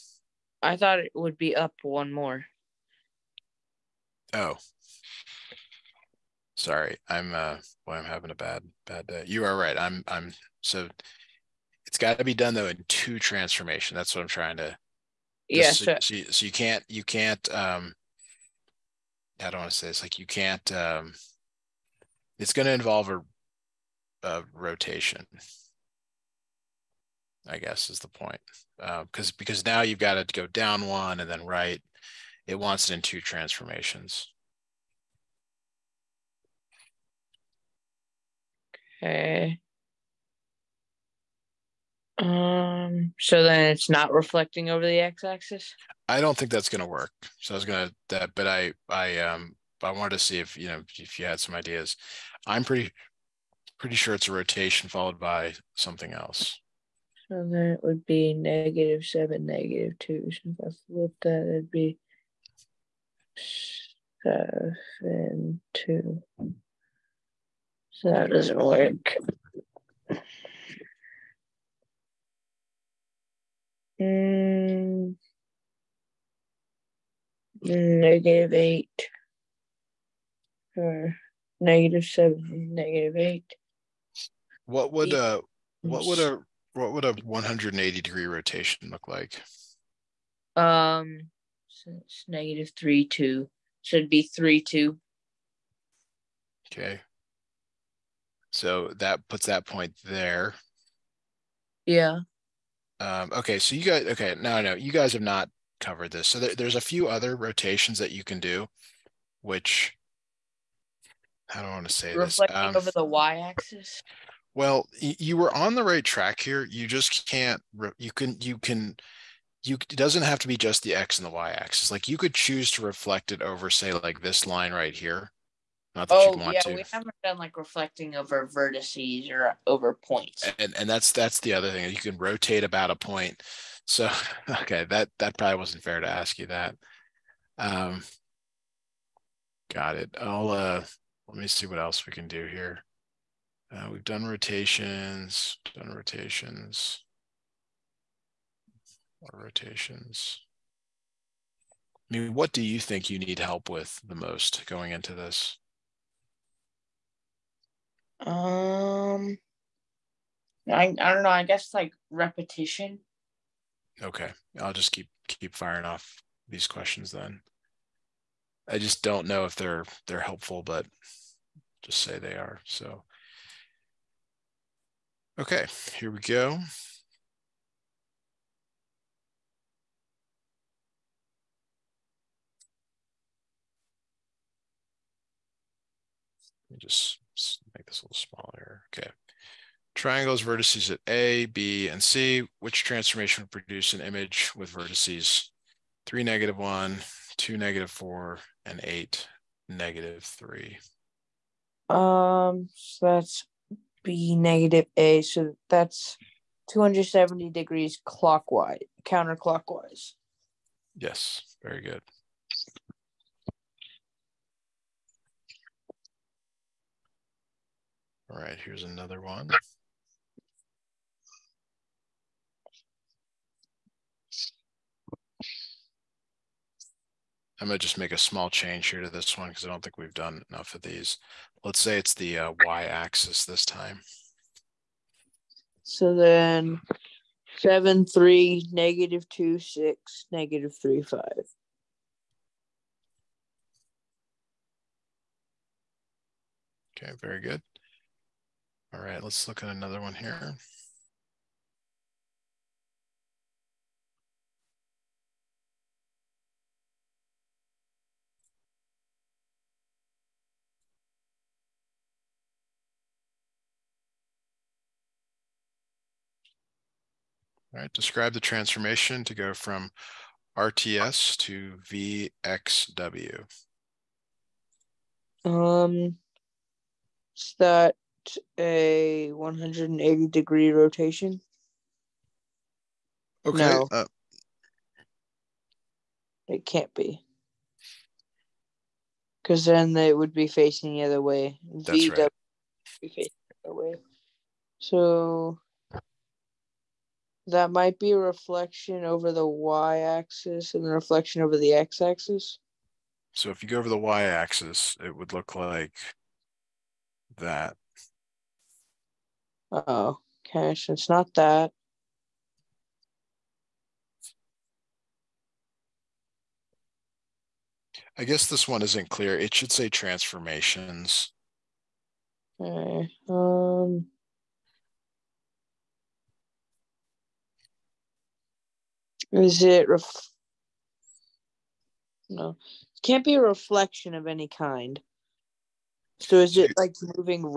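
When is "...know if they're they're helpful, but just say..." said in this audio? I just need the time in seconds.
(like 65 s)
169 s.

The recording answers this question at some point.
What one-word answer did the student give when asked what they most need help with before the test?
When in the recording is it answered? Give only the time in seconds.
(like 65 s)
162 s.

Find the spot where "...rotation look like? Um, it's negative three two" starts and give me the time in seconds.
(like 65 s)
88 s.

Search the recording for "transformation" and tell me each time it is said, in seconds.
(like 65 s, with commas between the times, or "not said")
13 s, 33 s, 192 s, 268 s, 319 s.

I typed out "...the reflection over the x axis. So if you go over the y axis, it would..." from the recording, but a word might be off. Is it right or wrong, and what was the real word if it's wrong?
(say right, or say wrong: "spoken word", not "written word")
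right.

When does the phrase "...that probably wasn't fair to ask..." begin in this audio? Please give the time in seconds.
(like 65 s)
135 s.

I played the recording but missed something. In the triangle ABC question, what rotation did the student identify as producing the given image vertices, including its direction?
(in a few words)
270 degrees counterclockwise.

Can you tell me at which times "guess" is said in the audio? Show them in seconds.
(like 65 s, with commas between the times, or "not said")
27 s, 161 s, 318 s.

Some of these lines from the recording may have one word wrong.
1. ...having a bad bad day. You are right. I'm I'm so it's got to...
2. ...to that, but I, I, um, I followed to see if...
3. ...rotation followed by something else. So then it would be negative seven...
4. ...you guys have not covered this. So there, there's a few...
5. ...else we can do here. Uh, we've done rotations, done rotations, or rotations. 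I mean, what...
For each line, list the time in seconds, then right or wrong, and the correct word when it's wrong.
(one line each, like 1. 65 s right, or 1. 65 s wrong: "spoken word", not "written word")
1. 8 s right
2. 47 s wrong: "wanted", not "followed"
3. 54 s right
4. 104 s right
5. 141 s right.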